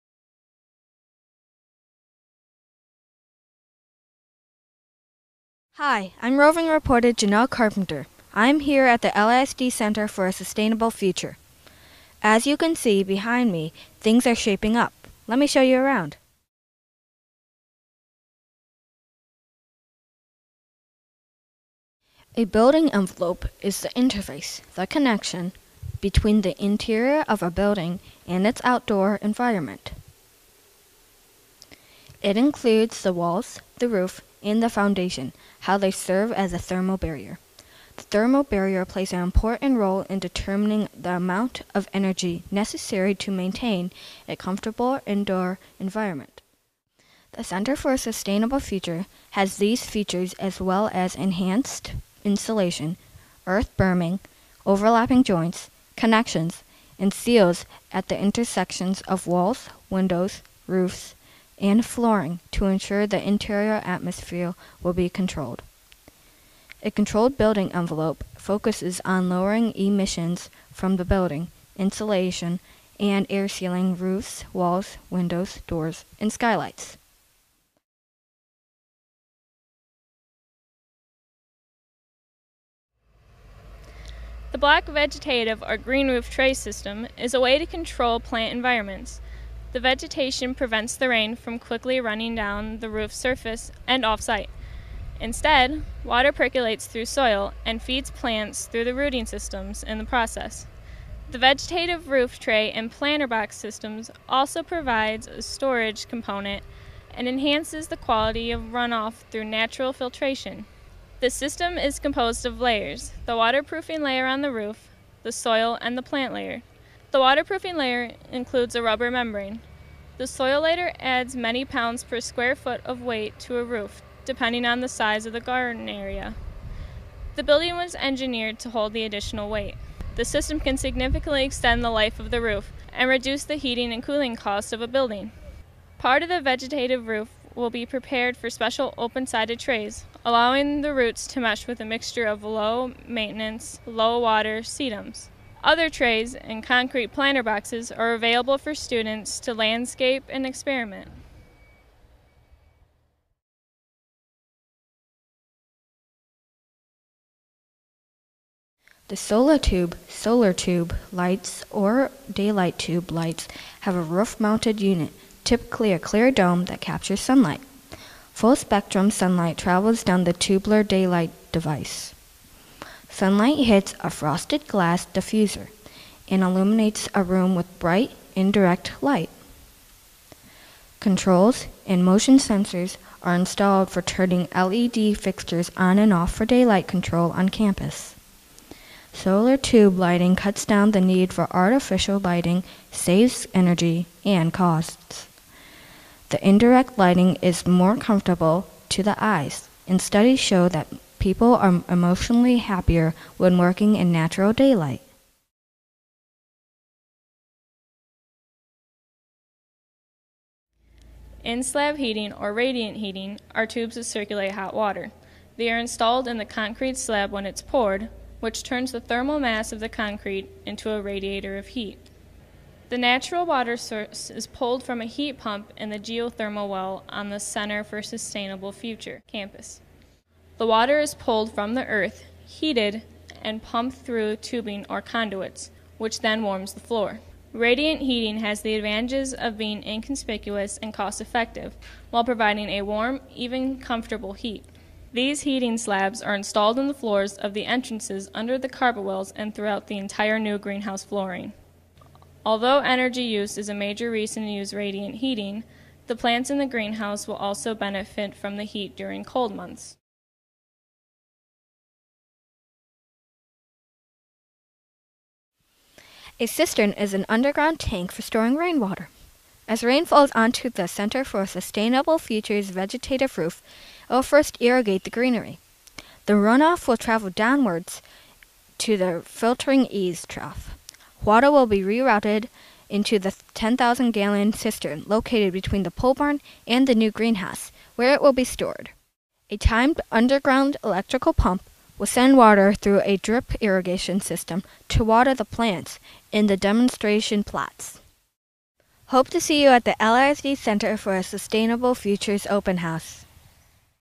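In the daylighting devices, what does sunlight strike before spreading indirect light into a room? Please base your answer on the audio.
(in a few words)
frosted glass diffuser.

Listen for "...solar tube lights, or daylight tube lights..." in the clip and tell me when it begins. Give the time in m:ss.
2:40.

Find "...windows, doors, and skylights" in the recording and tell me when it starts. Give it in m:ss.
1:15.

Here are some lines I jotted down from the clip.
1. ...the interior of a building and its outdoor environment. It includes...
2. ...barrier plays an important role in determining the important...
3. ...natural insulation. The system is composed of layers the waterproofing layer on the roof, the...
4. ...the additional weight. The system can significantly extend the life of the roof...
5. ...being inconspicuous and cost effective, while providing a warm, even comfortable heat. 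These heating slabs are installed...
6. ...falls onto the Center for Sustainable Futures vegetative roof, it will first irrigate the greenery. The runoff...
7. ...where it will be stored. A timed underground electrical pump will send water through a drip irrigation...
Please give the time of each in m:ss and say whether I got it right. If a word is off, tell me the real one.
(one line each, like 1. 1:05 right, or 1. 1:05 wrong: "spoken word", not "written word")
1. 0:26 right
2. 0:38 wrong: "amount", not "important"
3. 1:49 wrong: "filtration", not "insulation"
4. 2:08 right
5. 3:59 right
6. 4:30 right
7. 4:47 right.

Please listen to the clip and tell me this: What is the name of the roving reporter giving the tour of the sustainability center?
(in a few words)
Janelle Carpenter.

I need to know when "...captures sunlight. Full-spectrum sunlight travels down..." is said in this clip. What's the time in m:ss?
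2:46.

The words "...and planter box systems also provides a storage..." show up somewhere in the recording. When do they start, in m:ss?
1:42.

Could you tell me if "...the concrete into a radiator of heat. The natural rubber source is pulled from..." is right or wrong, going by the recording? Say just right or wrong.
wrong.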